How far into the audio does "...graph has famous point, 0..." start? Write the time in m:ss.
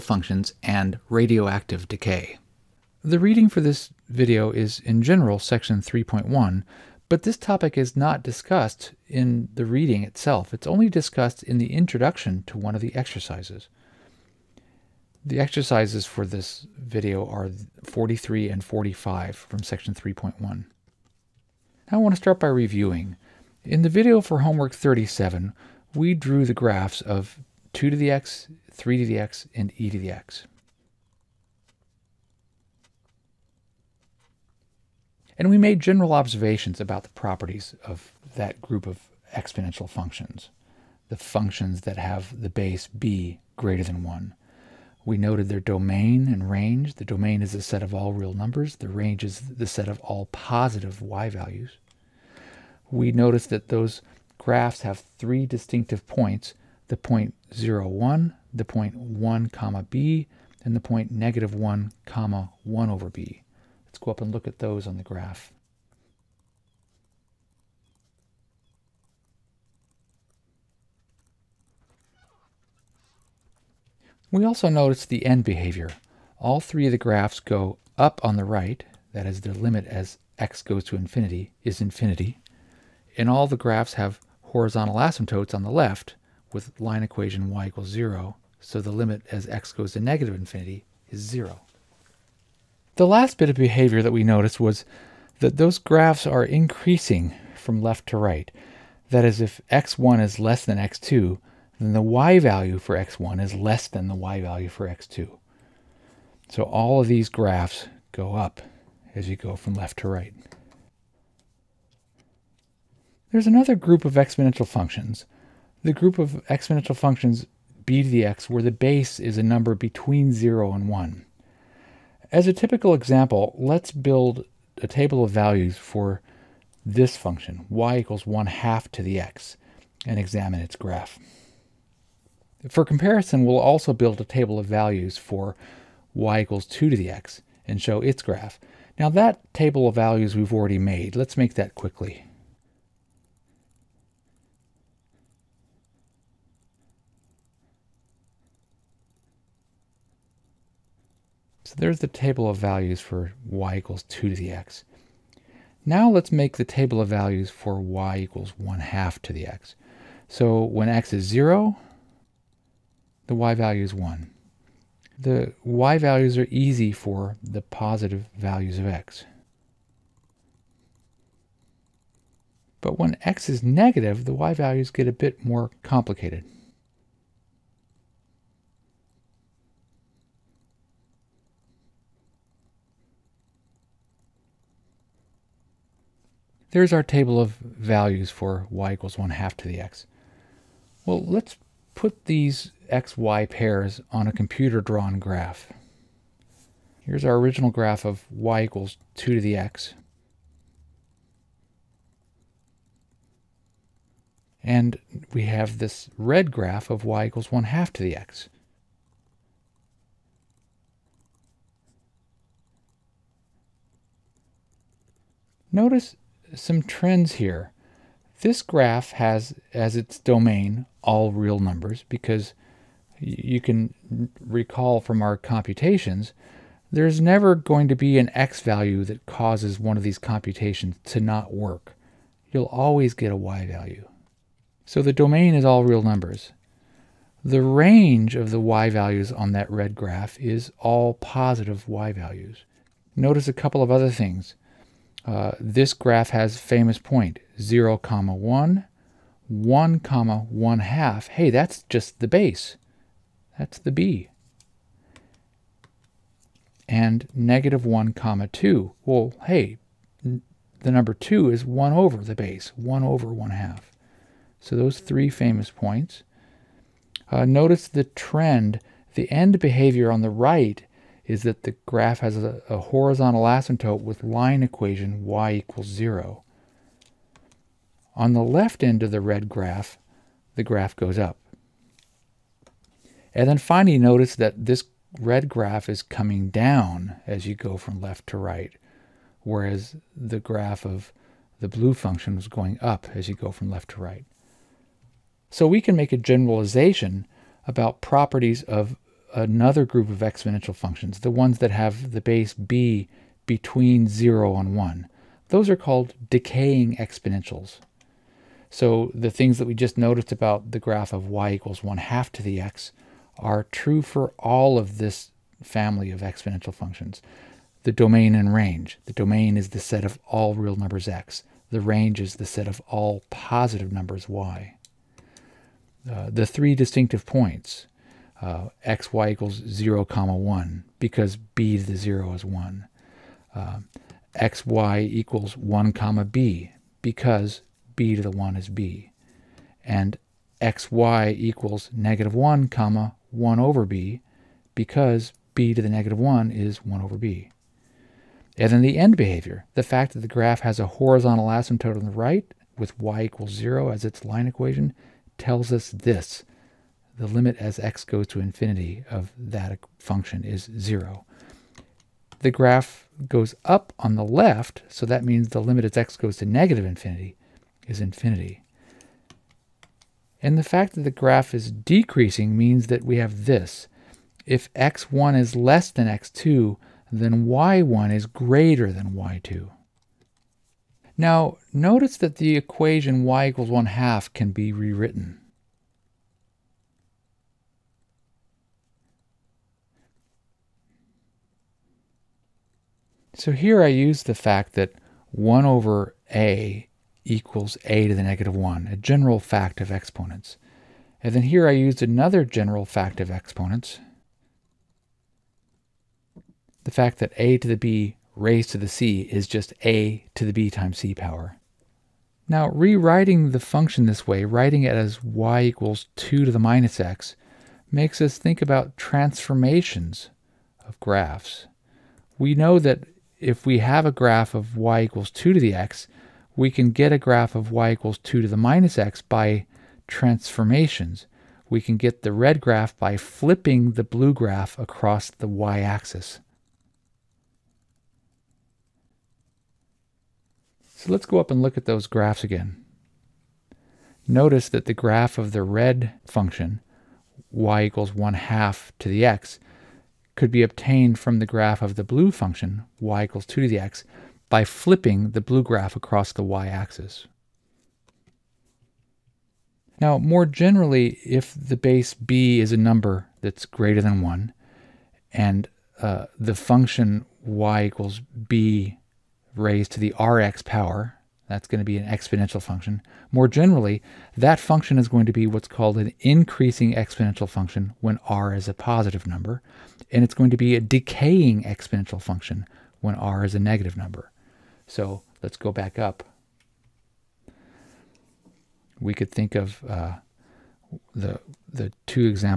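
4:05.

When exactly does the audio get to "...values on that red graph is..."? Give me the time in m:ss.
3:58.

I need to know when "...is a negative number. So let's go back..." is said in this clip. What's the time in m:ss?
8:03.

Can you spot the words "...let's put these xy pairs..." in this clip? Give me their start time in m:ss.
3:11.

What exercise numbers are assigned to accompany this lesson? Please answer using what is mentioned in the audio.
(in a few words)
43 and 45.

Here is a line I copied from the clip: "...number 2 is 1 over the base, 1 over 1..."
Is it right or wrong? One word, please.
right.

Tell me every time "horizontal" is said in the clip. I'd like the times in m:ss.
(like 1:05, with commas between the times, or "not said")
1:24, 4:32, 5:50.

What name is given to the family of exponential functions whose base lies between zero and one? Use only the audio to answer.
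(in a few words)
decaying exponentials.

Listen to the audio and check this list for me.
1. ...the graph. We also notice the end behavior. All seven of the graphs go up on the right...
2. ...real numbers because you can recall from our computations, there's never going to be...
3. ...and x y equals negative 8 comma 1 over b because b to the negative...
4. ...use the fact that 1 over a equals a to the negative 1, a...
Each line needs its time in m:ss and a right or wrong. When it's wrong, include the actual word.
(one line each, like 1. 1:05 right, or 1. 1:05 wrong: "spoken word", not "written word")
1. 1:04 wrong: "three", not "seven"
2. 3:41 right
3. 5:39 wrong: "1", not "8"
4. 6:33 right.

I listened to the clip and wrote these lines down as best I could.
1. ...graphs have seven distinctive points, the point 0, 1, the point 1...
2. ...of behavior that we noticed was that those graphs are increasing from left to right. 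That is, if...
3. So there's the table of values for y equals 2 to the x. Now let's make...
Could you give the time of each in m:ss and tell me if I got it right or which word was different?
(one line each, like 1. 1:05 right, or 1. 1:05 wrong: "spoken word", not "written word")
1. 0:54 wrong: "three", not "seven"
2. 1:33 right
3. 2:31 right.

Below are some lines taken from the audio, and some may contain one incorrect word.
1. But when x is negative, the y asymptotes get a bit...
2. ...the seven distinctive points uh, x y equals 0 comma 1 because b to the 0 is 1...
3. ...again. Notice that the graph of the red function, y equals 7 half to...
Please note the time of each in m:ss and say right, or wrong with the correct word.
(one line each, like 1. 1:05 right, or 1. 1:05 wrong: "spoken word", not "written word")
1. 2:52 wrong: "values", not "asymptotes"
2. 5:26 wrong: "three", not "seven"
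3. 7:22 wrong: "1", not "7".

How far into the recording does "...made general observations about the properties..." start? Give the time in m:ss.
0:35.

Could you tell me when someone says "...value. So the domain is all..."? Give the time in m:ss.
3:53.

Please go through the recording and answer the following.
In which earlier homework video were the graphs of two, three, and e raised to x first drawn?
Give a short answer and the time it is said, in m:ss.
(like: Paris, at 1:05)
37, at 0:24.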